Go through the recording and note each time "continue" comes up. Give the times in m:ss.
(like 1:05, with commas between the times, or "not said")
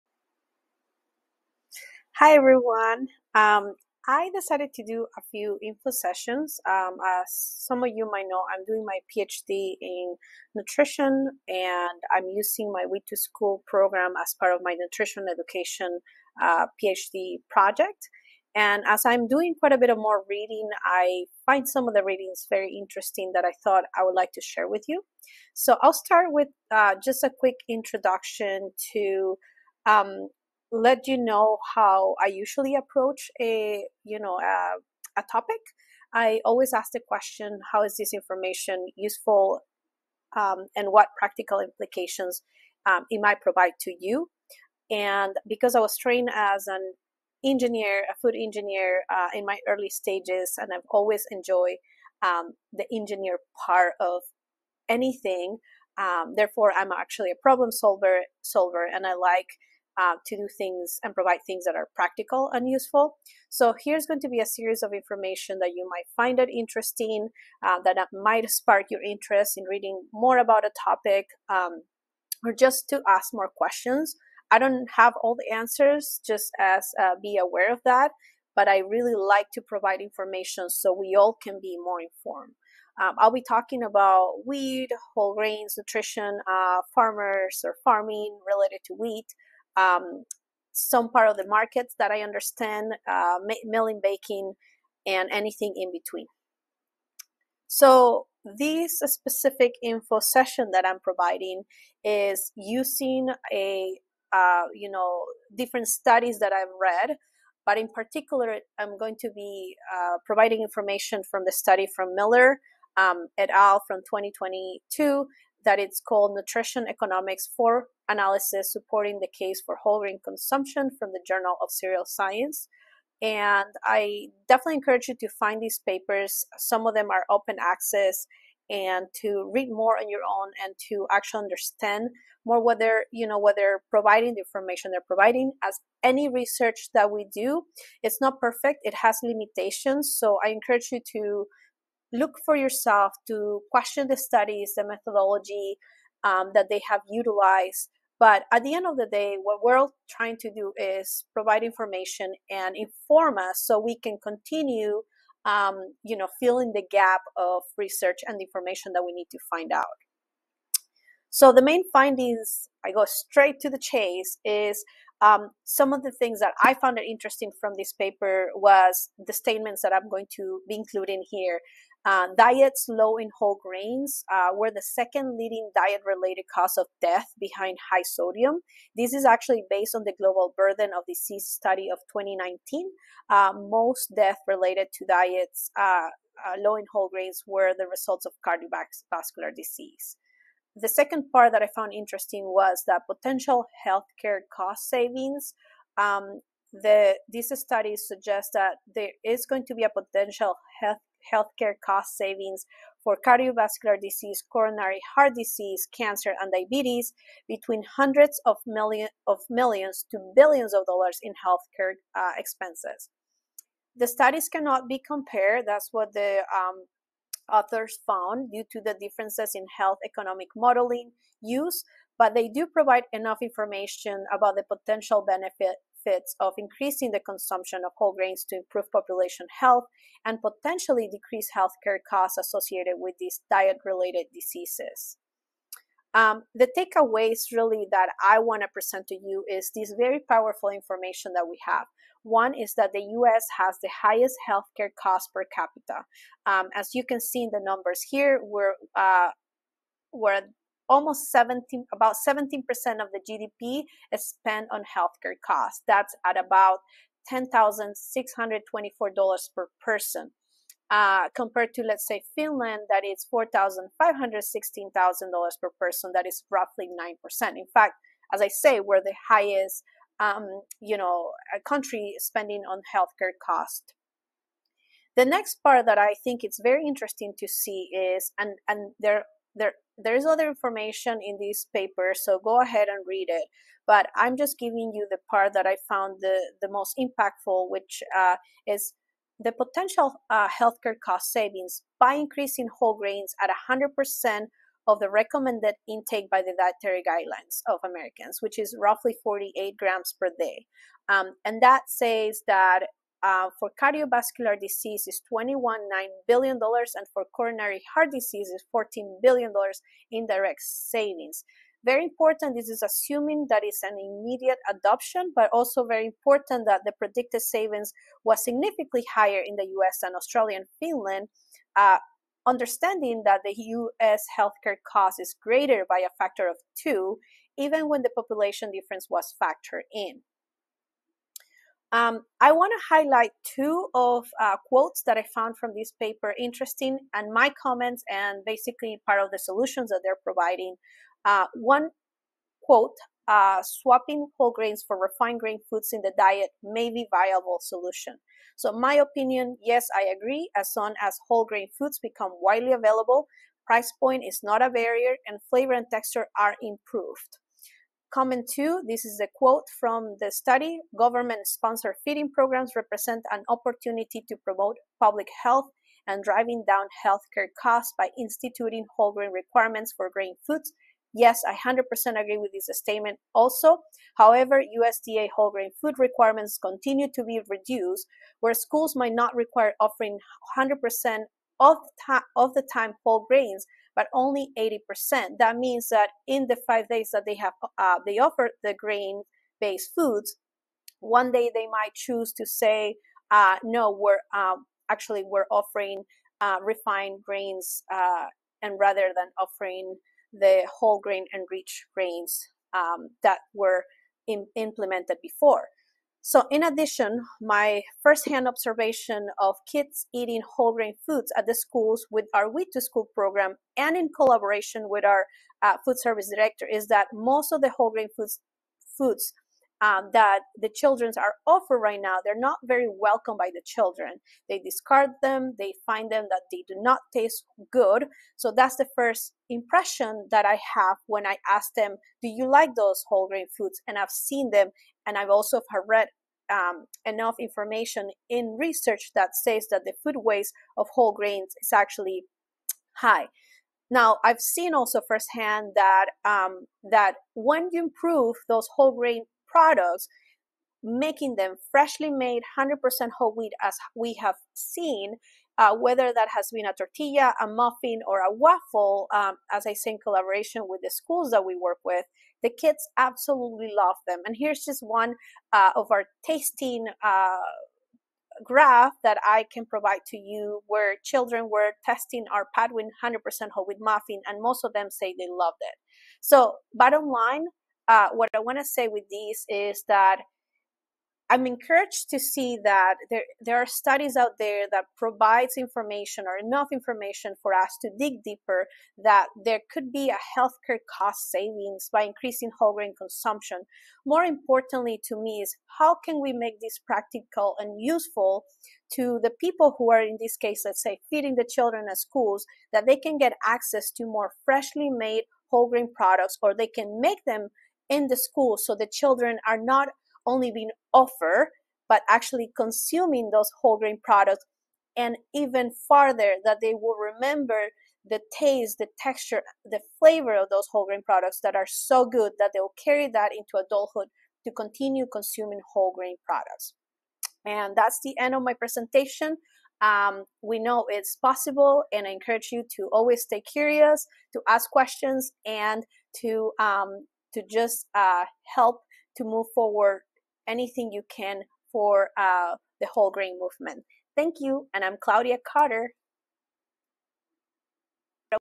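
2:34, 6:16, 8:44.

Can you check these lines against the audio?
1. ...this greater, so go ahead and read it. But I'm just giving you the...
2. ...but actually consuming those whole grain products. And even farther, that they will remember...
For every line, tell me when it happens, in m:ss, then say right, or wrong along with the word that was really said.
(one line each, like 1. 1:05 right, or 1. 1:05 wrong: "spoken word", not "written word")
1. 4:41 wrong: "paper", not "greater"
2. 8:31 right.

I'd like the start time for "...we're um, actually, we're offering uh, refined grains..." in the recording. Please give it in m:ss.
6:33.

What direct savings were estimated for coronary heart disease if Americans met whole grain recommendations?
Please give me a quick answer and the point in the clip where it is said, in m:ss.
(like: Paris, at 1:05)
14 billion dollars, at 5:08.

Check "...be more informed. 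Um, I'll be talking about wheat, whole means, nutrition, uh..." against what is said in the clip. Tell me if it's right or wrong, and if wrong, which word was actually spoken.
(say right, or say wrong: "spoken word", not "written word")
wrong: "grains", not "means".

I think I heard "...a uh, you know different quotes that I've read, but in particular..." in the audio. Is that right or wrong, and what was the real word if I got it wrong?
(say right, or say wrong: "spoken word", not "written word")
wrong: "studies", not "quotes".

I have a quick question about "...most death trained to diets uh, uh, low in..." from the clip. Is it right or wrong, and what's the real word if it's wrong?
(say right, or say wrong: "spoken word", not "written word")
wrong: "related", not "trained".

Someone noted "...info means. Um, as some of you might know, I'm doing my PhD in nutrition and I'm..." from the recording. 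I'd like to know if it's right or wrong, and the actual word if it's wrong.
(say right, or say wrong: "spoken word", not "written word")
wrong: "sessions", not "means".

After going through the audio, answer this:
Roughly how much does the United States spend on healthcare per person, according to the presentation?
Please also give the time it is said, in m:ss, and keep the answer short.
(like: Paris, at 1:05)
$10,624, at 4:17.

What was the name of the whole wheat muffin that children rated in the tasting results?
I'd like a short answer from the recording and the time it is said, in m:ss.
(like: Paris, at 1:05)
Patwin, at 7:52.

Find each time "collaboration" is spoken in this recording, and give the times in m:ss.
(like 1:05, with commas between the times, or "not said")
6:54, 7:40.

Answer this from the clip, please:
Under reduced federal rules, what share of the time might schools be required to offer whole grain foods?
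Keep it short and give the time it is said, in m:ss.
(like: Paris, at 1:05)
80%, at 6:24.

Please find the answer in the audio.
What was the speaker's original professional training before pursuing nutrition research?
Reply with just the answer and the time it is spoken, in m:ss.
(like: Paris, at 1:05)
Food engineer, at 0:48.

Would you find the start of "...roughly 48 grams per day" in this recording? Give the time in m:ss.
4:58.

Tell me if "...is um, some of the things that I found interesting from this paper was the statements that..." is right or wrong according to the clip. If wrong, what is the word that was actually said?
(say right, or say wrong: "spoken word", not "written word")
right.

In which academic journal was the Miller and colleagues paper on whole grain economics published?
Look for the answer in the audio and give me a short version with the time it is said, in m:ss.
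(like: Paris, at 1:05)
Journal of Cereal Science, at 2:01.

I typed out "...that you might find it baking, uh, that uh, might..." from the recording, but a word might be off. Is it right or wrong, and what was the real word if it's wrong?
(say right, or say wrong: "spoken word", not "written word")
wrong: "interesting", not "baking".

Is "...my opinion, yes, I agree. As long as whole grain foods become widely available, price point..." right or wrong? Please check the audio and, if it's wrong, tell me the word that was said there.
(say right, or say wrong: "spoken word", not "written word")
right.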